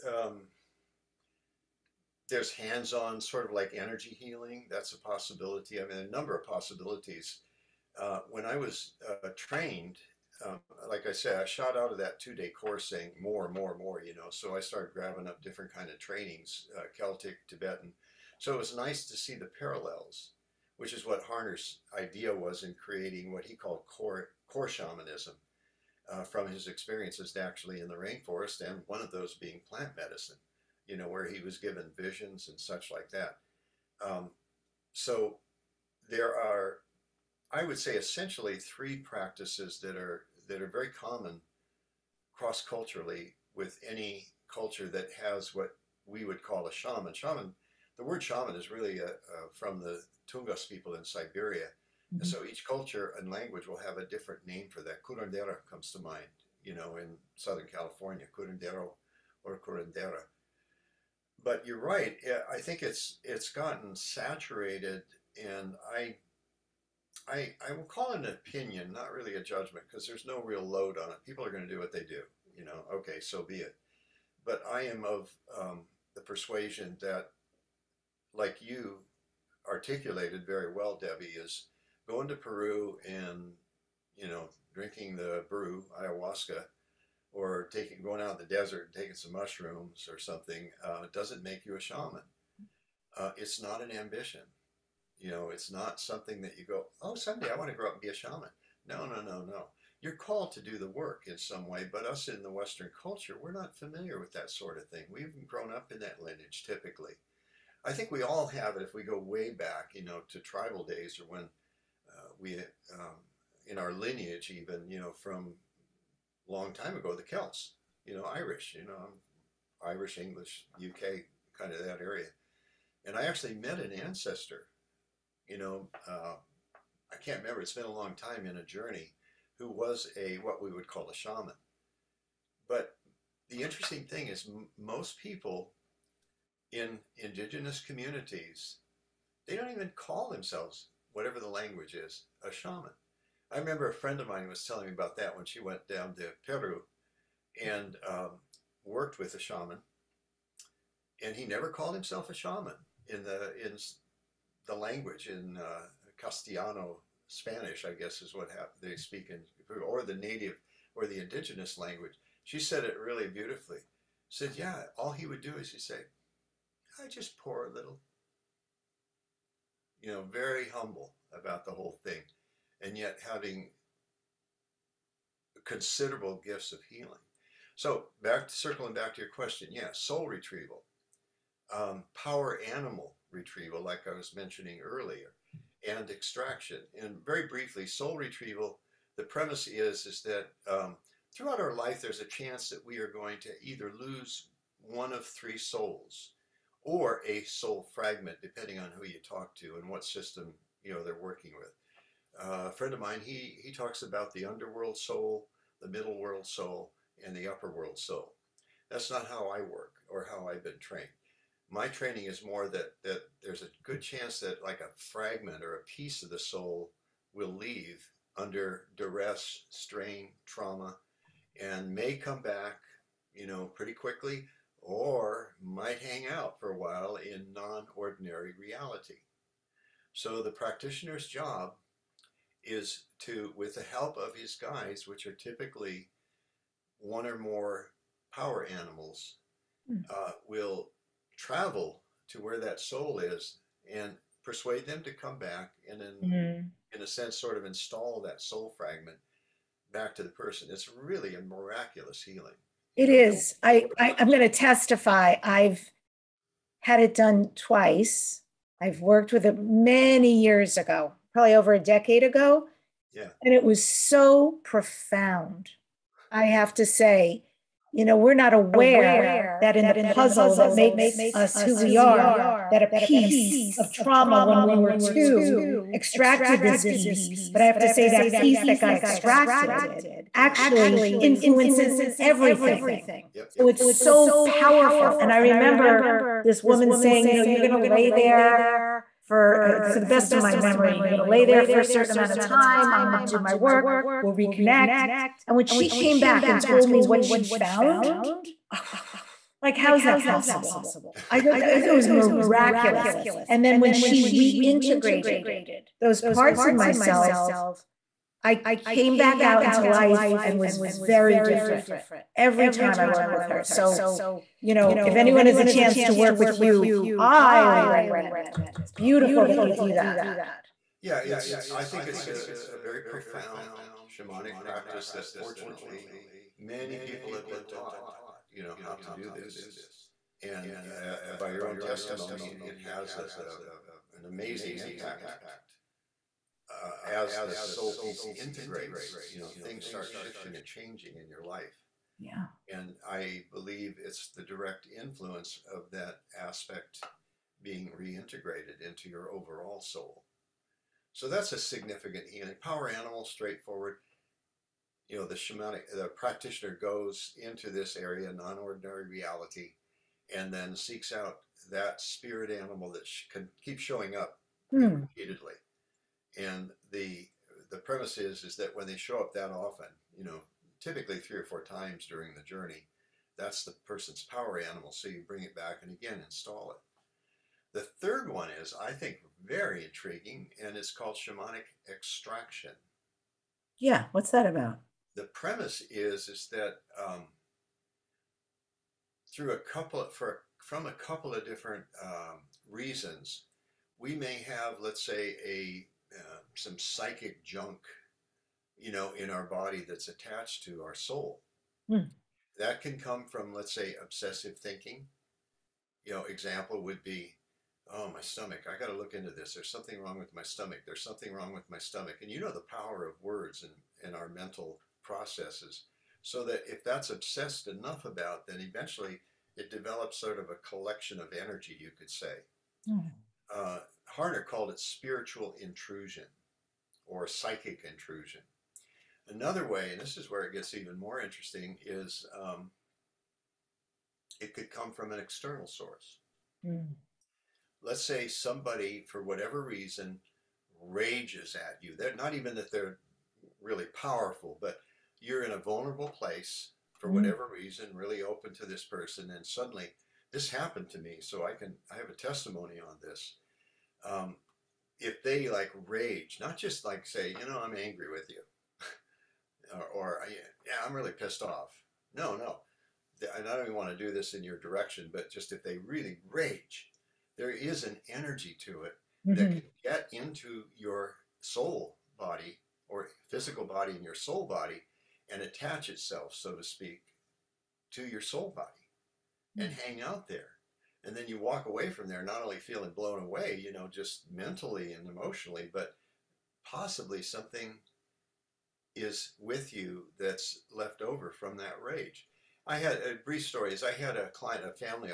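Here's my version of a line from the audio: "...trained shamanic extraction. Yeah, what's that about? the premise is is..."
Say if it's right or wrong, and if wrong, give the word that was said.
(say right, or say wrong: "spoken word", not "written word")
wrong: "called", not "trained".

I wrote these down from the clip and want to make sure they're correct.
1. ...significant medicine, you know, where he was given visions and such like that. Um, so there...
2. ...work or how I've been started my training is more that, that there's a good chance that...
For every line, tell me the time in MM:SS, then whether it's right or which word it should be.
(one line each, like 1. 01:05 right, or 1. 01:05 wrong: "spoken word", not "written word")
1. 00:29 wrong: "plant", not "significant"
2. 03:29 wrong: "trained", not "started".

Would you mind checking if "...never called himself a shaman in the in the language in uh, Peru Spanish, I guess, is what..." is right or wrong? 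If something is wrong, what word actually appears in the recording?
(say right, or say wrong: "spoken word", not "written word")
wrong: "Castellano", not "Peru".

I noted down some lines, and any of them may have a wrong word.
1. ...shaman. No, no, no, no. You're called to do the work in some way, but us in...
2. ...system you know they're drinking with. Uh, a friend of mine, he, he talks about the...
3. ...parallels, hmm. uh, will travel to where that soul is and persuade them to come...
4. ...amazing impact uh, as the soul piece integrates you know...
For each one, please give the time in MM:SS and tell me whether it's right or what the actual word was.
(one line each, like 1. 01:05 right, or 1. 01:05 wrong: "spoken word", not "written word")
1. 01:38 right
2. 03:20 wrong: "working", not "drinking"
3. 03:58 wrong: "animals", not "parallels"
4. 05:34 right.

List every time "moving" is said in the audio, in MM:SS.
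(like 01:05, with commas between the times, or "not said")
not said.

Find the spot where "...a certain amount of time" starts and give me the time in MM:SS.
04:51.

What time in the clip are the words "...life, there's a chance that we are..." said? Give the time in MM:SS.
03:11.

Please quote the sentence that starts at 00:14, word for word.
So I started grabbing up different kind of trainings, uh, Celtic, Tibetan.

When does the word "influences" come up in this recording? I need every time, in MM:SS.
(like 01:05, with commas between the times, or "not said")
04:41, 05:44.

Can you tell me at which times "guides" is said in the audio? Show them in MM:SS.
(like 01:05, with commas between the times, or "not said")
03:54.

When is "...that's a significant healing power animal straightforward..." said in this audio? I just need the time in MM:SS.
05:51.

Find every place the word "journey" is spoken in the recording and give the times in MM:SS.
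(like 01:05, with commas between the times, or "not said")
02:08, 06:12.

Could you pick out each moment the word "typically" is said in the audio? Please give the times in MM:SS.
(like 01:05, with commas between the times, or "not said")
01:46, 03:55, 06:10.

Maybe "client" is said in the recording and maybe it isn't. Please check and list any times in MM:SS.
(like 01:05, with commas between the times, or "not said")
08:14.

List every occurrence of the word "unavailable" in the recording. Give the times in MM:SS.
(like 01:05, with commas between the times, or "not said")
not said.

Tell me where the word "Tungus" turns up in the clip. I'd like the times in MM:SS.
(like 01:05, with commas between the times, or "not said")
00:50.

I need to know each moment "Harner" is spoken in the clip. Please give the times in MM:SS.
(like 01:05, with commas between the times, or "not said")
00:21, 07:04.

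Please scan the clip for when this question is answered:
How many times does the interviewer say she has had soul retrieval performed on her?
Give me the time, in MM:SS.
04:17.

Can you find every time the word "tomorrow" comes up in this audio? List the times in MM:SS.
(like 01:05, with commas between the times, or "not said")
not said.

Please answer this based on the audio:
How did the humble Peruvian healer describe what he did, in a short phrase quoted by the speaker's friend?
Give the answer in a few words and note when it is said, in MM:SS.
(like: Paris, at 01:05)
I just pour a little, at 02:47.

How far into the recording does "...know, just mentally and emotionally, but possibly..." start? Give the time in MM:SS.
08:03.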